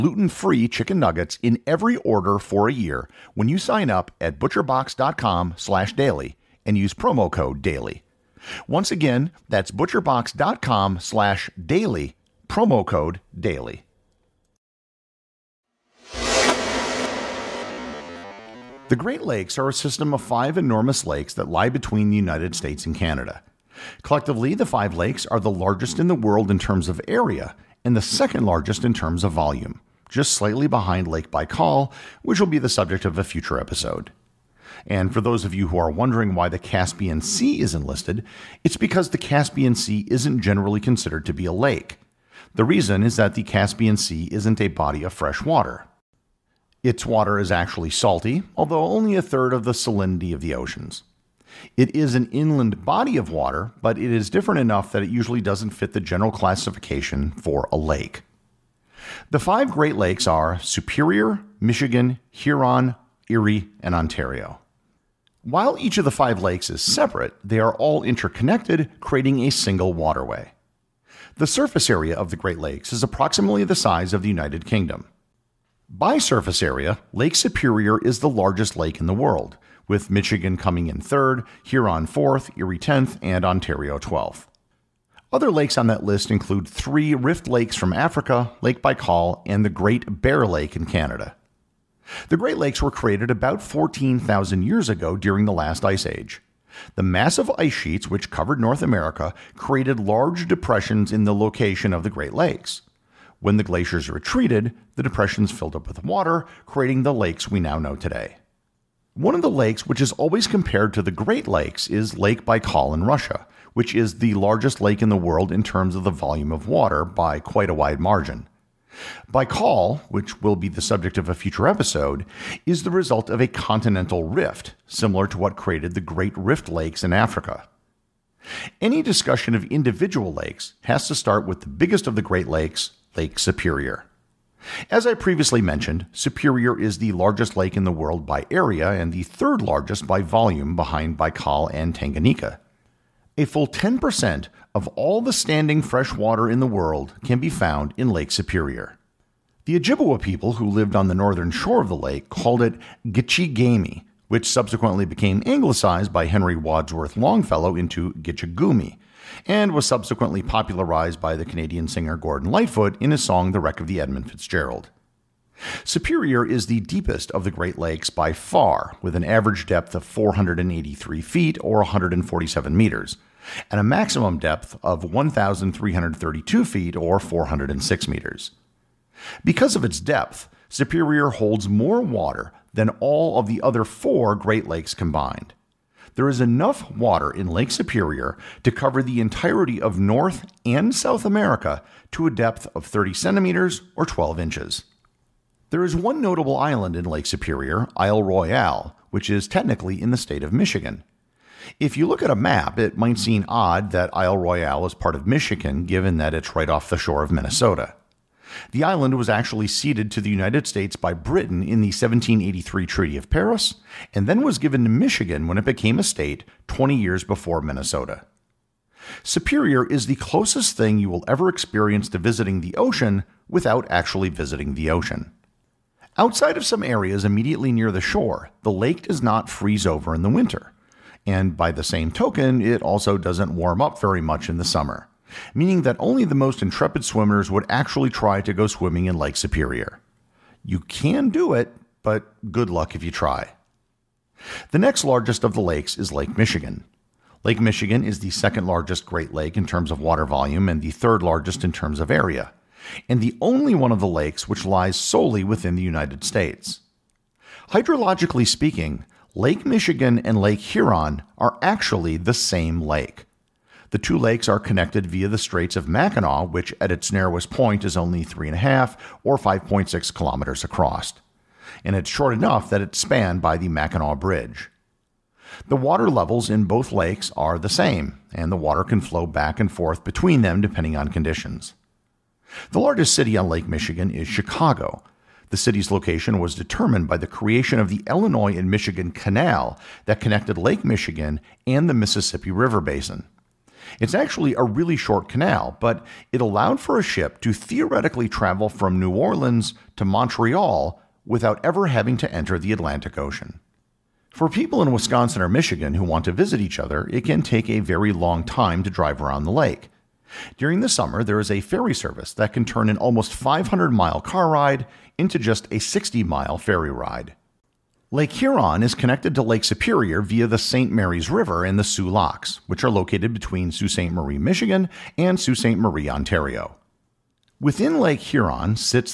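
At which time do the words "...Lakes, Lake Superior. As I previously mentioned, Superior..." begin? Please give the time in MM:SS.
02:12.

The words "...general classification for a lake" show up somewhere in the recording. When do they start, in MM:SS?
00:55.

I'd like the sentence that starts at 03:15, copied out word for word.
There is one notable island in Lake Superior, Isle Royale, which is technically in the state of Michigan.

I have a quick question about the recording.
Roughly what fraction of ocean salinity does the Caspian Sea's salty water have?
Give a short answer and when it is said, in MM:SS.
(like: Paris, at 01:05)
a third, at 00:49.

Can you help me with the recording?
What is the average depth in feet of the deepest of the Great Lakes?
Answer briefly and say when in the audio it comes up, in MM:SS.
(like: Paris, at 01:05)
483 feet, at 02:50.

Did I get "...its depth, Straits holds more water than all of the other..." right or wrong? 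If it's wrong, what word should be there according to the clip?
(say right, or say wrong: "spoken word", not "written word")
wrong: "Superior", not "Straits".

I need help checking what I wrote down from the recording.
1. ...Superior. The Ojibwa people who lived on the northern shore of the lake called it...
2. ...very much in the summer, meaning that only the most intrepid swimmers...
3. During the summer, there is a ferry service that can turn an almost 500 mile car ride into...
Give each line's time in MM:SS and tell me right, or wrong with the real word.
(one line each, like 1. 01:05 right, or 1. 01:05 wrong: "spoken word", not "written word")
1. 02:28 right
2. 03:53 right
3. 05:10 right.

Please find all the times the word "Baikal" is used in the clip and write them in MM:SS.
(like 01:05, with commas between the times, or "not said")
00:31, 01:28, 01:52, 01:59, 02:21.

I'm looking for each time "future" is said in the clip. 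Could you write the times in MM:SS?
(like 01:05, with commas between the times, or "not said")
00:33, 02:01.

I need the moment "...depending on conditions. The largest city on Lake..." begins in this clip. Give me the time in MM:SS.
04:40.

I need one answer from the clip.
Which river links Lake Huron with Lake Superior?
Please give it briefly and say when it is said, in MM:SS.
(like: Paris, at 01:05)
St. Mary's River, at 05:20.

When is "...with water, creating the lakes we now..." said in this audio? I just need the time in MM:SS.
01:45.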